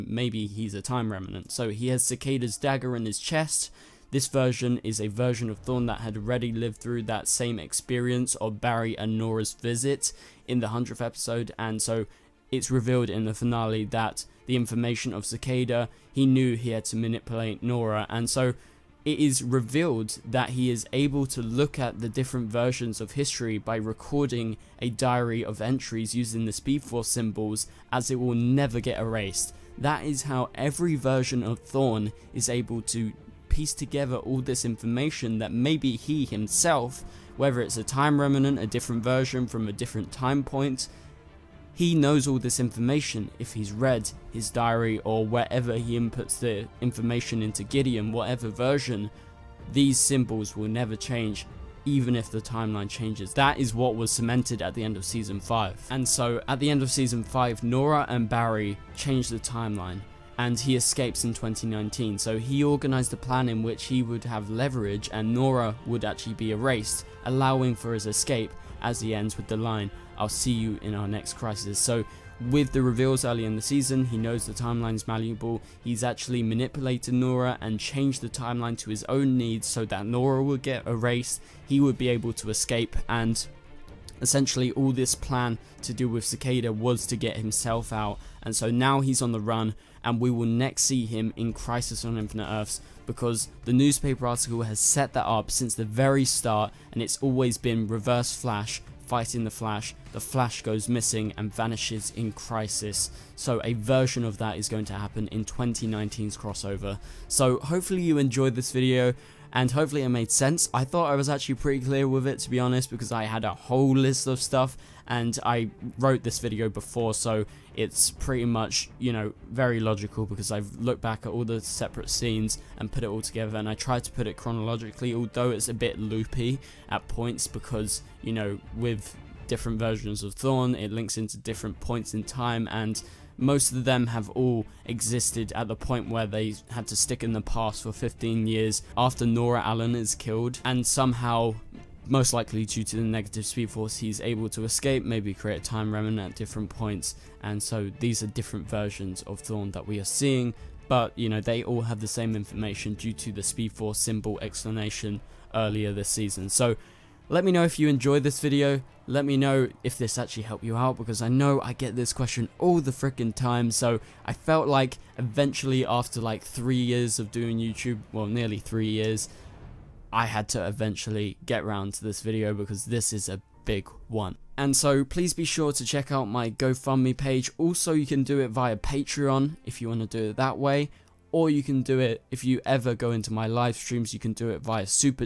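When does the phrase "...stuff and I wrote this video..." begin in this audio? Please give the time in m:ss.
1:54.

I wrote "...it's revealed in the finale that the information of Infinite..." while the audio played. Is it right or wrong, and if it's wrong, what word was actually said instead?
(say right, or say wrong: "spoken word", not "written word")
wrong: "Cicada", not "Infinite".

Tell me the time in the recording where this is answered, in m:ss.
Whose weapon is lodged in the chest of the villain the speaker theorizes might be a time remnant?
0:02.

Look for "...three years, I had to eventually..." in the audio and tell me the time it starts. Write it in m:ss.
2:48.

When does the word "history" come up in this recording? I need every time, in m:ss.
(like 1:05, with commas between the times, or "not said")
0:23.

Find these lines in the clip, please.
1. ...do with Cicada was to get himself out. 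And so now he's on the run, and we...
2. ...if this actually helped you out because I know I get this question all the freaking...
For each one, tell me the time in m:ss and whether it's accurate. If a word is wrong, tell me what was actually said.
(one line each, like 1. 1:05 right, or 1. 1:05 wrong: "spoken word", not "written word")
1. 1:25 right
2. 2:39 right.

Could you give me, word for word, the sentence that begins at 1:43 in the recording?
So a version of that is going to happen in 2019's crossover.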